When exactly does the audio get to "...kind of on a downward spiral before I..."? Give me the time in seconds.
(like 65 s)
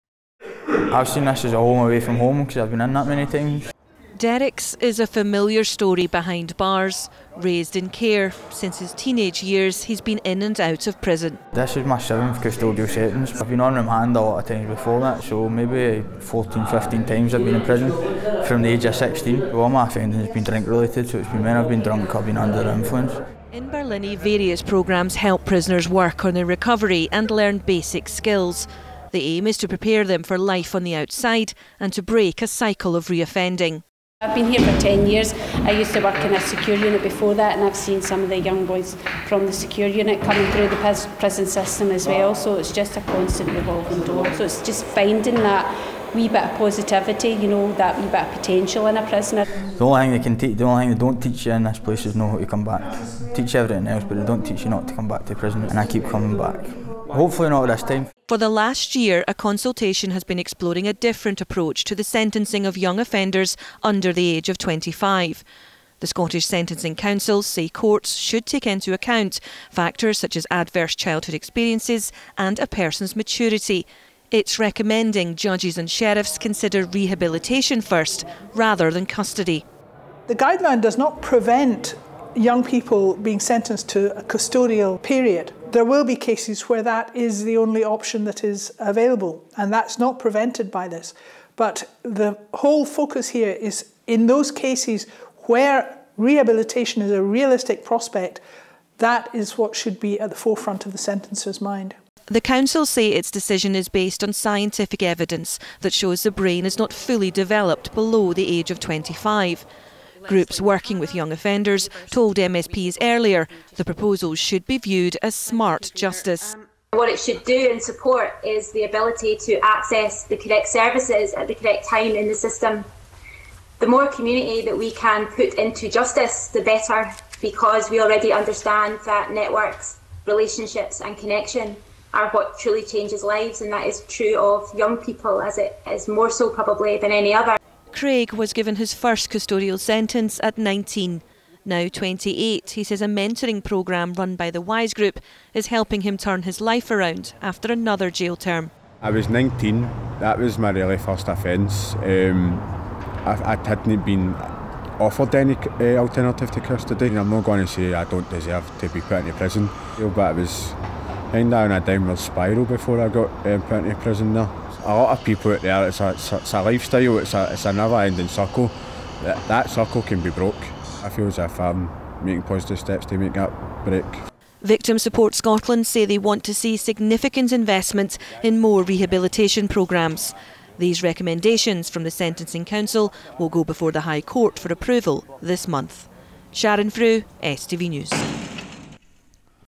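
161 s.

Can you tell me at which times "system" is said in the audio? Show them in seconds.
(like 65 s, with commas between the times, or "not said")
41 s, 122 s.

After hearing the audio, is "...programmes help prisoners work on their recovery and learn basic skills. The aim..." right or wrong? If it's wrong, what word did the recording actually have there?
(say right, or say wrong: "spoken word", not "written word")
right.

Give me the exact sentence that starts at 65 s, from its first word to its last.
The Scottish Sentencing Council say courts should take into account factors such as adverse childhood experiences and a person's maturity.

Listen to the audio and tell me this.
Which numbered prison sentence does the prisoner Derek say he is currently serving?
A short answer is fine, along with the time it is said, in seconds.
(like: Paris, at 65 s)
7th, at 11 s.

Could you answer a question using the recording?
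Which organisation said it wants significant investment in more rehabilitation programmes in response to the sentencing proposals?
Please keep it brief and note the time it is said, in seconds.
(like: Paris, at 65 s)
Victim Support Scotland, at 174 s.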